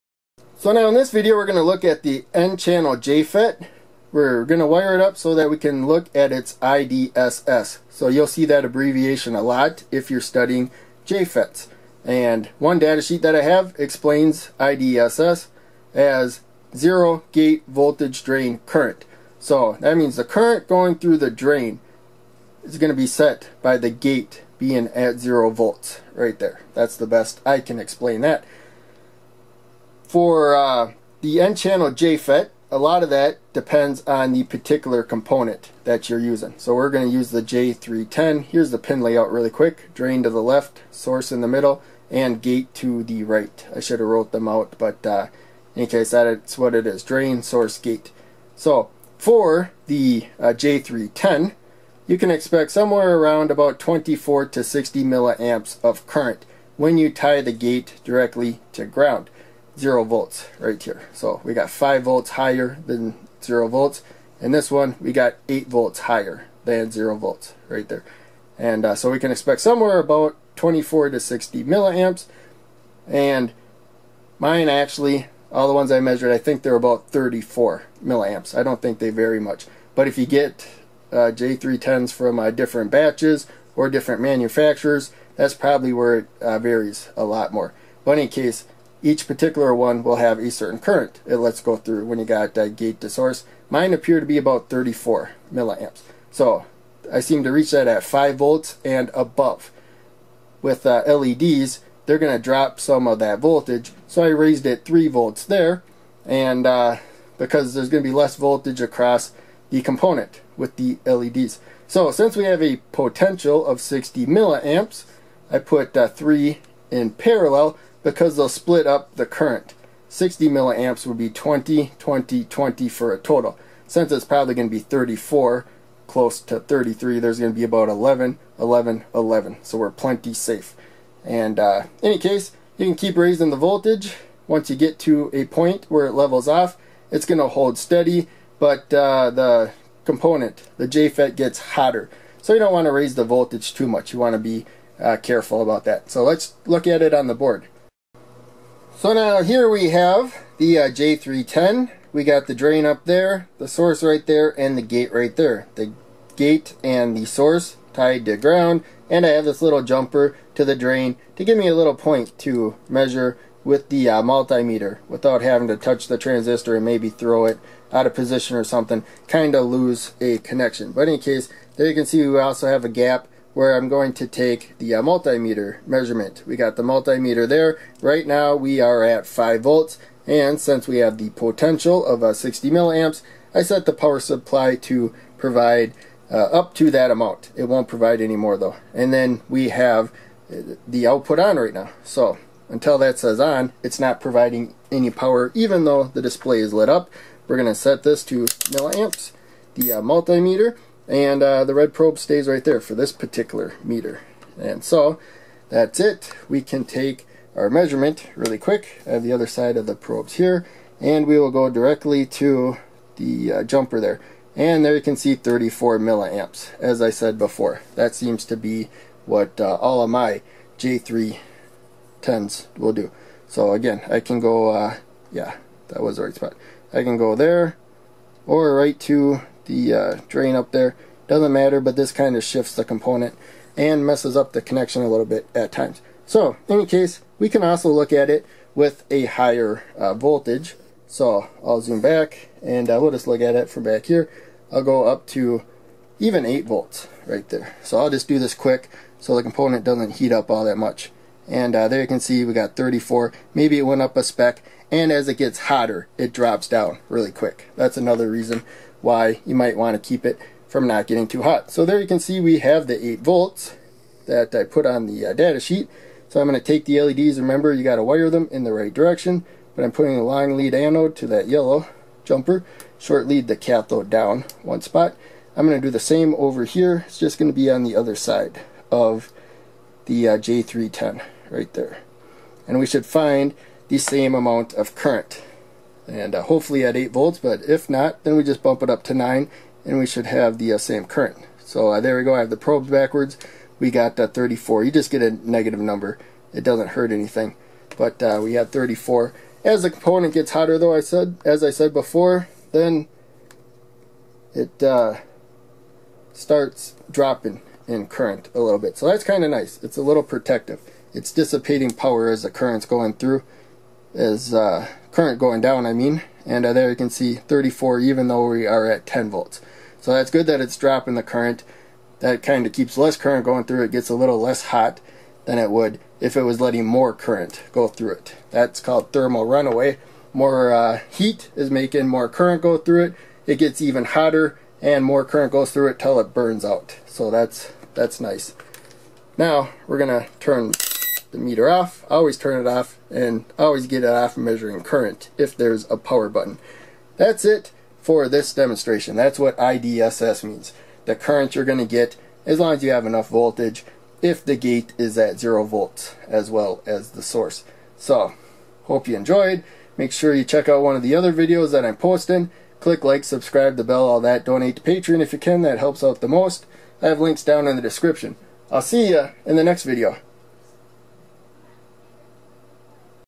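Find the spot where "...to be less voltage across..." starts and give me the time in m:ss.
1:48.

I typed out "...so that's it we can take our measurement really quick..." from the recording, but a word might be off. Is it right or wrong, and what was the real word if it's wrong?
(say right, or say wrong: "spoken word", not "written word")
right.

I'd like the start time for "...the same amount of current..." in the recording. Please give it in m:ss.
4:43.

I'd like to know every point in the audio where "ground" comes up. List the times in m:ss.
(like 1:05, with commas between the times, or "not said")
0:58, 2:38.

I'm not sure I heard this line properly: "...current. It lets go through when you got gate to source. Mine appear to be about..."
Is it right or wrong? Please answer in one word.
right.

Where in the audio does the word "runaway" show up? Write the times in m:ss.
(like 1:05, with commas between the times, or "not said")
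5:29.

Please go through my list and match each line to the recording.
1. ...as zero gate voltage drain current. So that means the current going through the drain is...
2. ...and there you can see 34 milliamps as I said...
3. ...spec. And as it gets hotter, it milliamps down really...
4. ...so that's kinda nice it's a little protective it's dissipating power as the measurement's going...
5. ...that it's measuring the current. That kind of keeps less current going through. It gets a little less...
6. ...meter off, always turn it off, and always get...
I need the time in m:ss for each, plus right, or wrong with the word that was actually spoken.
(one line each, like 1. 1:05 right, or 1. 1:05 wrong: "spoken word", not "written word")
1. 0:15 right
2. 3:34 right
3. 4:14 wrong: "drops", not "milliamps"
4. 5:08 wrong: "current", not "measurement"
5. 5:20 wrong: "dropping", not "measuring"
6. 5:41 right.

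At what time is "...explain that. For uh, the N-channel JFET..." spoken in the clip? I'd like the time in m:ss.
0:27.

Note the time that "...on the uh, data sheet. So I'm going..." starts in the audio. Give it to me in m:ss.
4:24.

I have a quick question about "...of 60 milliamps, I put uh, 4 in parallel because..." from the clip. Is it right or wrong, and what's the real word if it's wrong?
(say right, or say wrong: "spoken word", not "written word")
wrong: "3", not "4".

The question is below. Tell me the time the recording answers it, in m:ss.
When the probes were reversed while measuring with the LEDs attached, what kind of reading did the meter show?
4:55.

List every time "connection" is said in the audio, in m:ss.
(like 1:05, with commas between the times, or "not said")
2:50, 3:54.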